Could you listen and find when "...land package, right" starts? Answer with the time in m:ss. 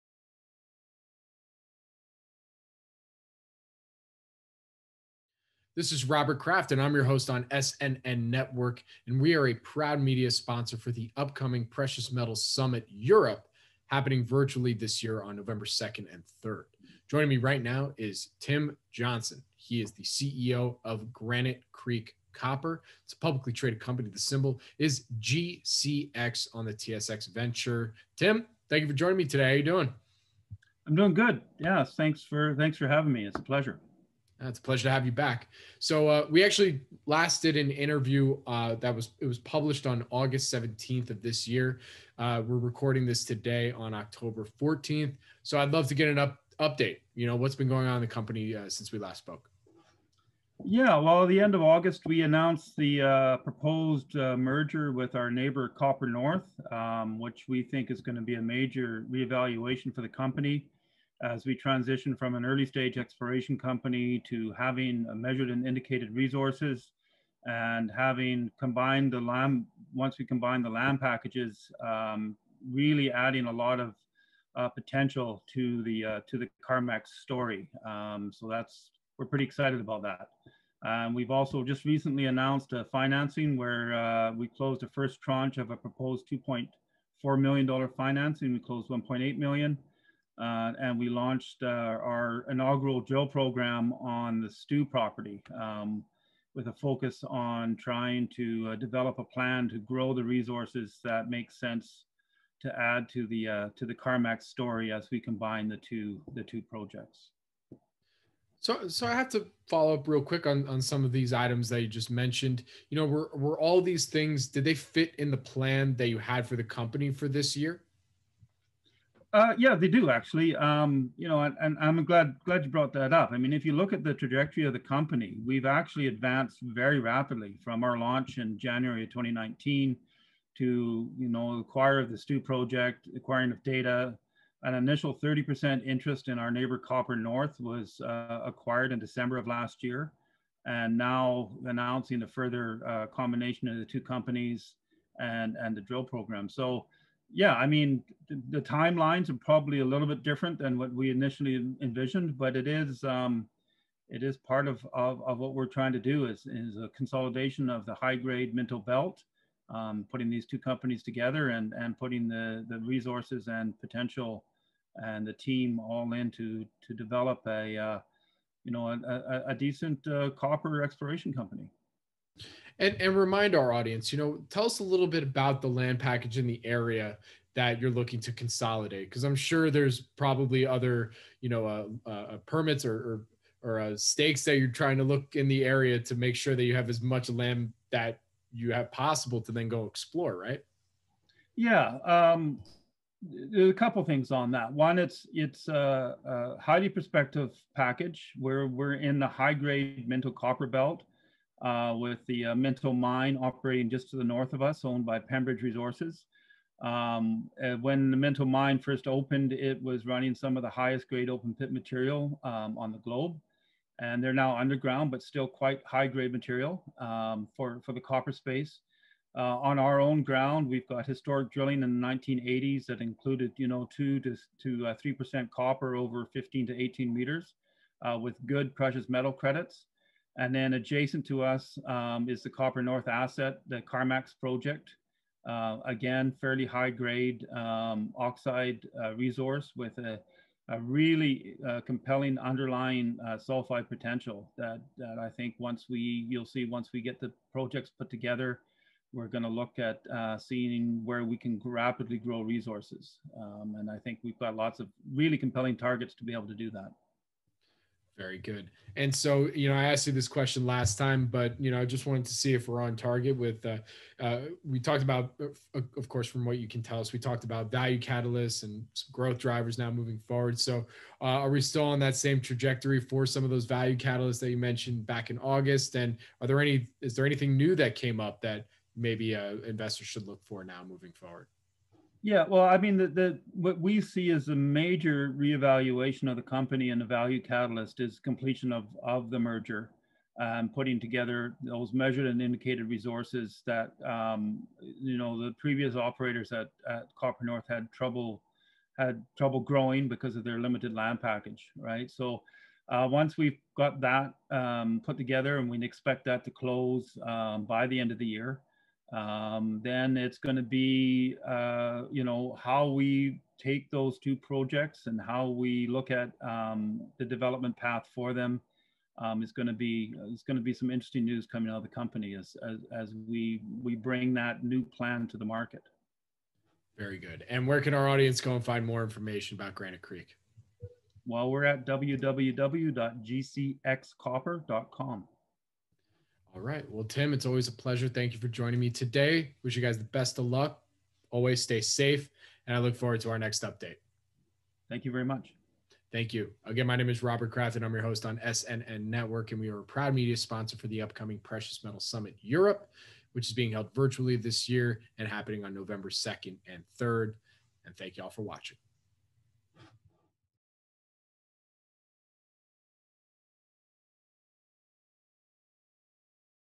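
5:00.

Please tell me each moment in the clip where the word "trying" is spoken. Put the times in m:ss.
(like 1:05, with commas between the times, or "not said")
1:37, 2:35, 3:04.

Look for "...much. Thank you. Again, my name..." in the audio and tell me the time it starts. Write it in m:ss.
5:45.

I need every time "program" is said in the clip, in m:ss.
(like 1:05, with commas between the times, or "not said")
1:33, 2:26.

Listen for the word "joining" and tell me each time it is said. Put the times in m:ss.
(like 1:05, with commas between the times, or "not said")
0:17, 0:28, 5:38.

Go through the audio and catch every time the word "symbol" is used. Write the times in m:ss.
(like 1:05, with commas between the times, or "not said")
0:24.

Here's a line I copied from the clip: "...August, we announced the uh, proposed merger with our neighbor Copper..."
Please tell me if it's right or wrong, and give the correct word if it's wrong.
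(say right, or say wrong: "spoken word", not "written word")
right.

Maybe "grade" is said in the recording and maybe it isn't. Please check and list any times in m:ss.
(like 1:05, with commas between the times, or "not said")
2:38, 3:19, 3:31, 3:36, 3:56.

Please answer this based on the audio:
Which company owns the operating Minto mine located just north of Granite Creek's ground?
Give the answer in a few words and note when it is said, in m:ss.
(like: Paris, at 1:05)
Pembridge Resources, at 3:25.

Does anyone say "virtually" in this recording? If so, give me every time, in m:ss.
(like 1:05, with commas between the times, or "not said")
0:14, 5:53.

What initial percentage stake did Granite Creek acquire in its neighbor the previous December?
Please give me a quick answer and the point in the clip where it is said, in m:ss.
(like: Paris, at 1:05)
30%, at 2:15.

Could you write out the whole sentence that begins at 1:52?
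You know, were, were all these things, did they fit in the plan that you had for the company for this year?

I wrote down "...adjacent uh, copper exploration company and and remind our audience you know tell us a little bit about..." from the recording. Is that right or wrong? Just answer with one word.
wrong.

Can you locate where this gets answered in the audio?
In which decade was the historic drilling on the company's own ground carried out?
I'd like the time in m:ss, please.
3:42.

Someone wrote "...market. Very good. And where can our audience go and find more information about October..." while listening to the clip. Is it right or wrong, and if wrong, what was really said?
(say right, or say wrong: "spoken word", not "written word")
wrong: "Granite", not "October".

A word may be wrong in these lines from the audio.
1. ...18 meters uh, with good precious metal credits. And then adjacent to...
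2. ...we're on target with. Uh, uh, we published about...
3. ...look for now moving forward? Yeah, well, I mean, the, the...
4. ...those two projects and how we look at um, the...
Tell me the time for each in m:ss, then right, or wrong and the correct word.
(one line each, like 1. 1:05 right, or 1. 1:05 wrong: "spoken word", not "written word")
1. 3:46 right
2. 4:22 wrong: "talked", not "published"
3. 4:40 right
4. 5:13 right.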